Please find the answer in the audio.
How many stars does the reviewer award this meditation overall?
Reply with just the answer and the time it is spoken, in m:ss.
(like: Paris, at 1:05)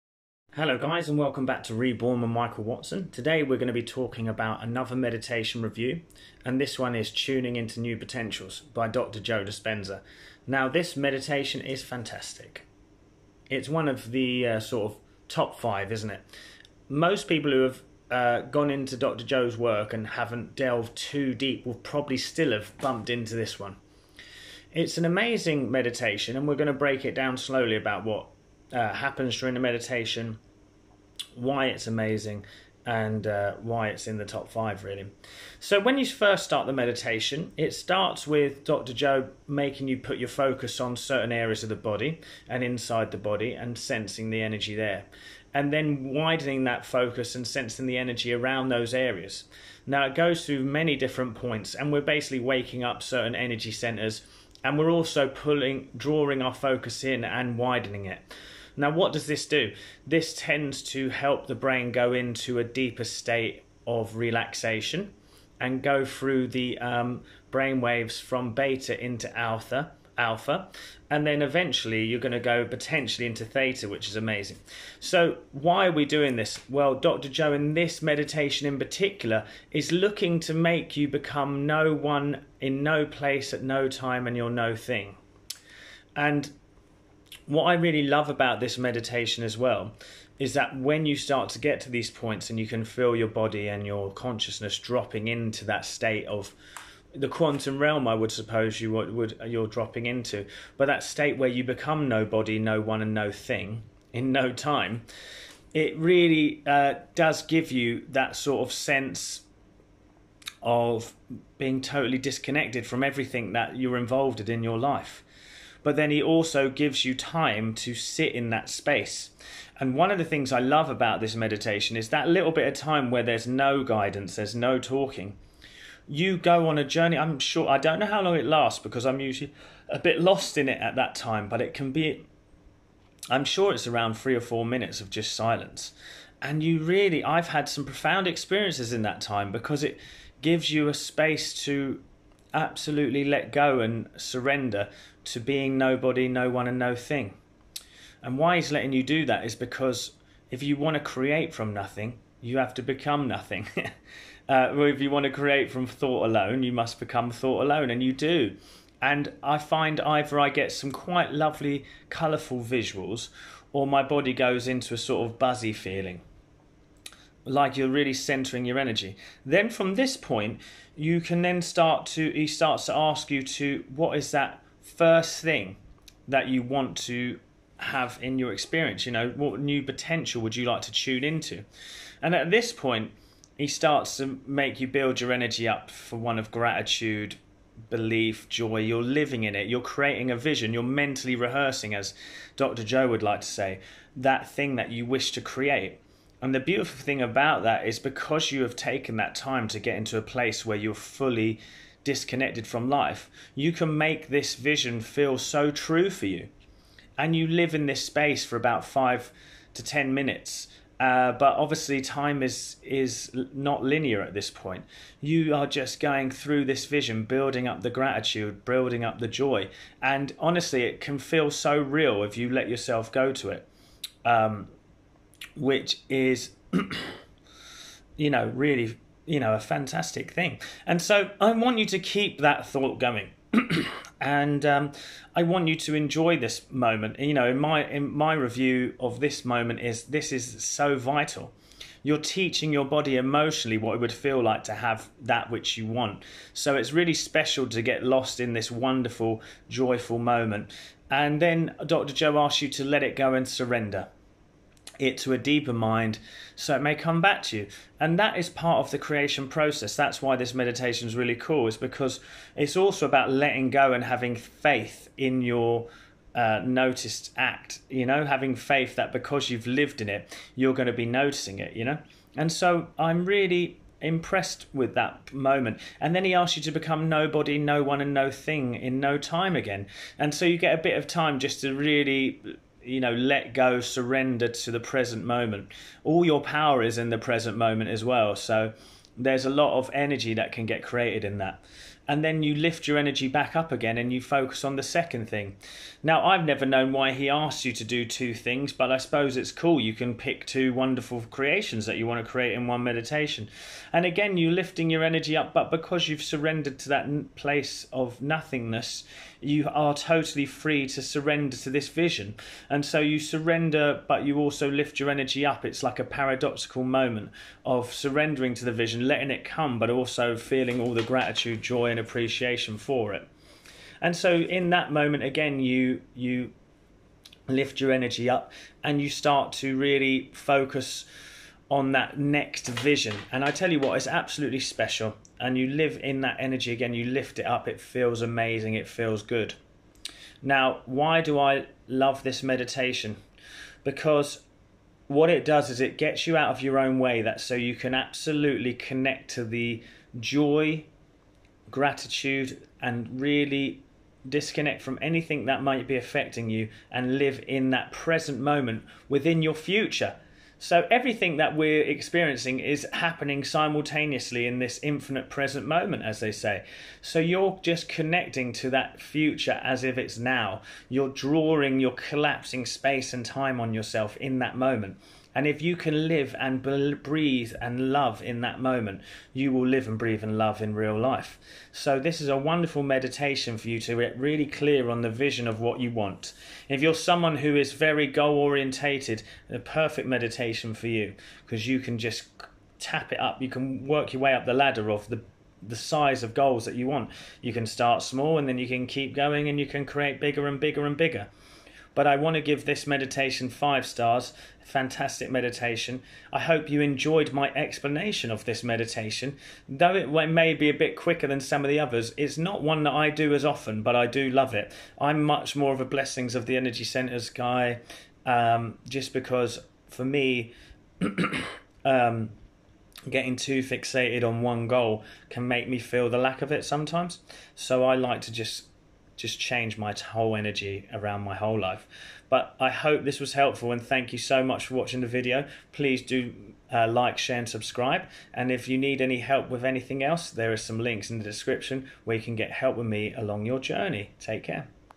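5 stars, at 6:43.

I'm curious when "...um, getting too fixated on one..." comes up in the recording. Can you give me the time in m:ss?
7:01.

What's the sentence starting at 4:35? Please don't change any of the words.
And then he asks you to become nobody, no one, and no thing in no time again.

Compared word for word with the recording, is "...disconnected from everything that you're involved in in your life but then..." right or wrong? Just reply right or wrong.
right.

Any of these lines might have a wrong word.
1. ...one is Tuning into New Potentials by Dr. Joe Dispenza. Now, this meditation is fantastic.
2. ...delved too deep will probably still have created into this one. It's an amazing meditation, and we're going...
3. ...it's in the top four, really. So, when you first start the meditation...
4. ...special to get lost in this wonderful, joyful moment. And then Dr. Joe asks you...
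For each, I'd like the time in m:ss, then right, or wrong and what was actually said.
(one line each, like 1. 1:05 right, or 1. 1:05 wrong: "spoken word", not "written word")
1. 0:06 right
2. 0:20 wrong: "bumped", not "created"
3. 0:33 wrong: "five", not "four"
4. 4:07 right.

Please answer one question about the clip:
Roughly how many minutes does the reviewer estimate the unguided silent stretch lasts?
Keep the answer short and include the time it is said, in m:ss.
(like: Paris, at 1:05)
3 or 4 minutes, at 2:14.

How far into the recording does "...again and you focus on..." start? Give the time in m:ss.
4:53.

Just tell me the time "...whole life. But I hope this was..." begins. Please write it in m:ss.
7:11.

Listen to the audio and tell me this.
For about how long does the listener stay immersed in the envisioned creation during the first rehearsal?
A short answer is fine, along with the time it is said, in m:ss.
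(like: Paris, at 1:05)
5 to 10 minutes, at 3:28.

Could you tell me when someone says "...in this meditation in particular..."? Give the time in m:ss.
1:17.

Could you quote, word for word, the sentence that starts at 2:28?
And why he's letting you do that is because if you want to create from nothing, you have to become nothing.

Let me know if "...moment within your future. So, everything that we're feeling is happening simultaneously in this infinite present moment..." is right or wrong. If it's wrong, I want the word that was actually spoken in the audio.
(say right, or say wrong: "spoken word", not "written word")
wrong: "experiencing", not "feeling".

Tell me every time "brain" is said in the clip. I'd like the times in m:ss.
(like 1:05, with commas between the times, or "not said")
1:01, 1:07.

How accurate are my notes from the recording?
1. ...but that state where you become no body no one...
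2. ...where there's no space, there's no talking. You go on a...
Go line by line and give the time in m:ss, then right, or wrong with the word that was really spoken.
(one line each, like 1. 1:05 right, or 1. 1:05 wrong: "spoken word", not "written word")
1. 1:40 right
2. 2:03 wrong: "guidance", not "space".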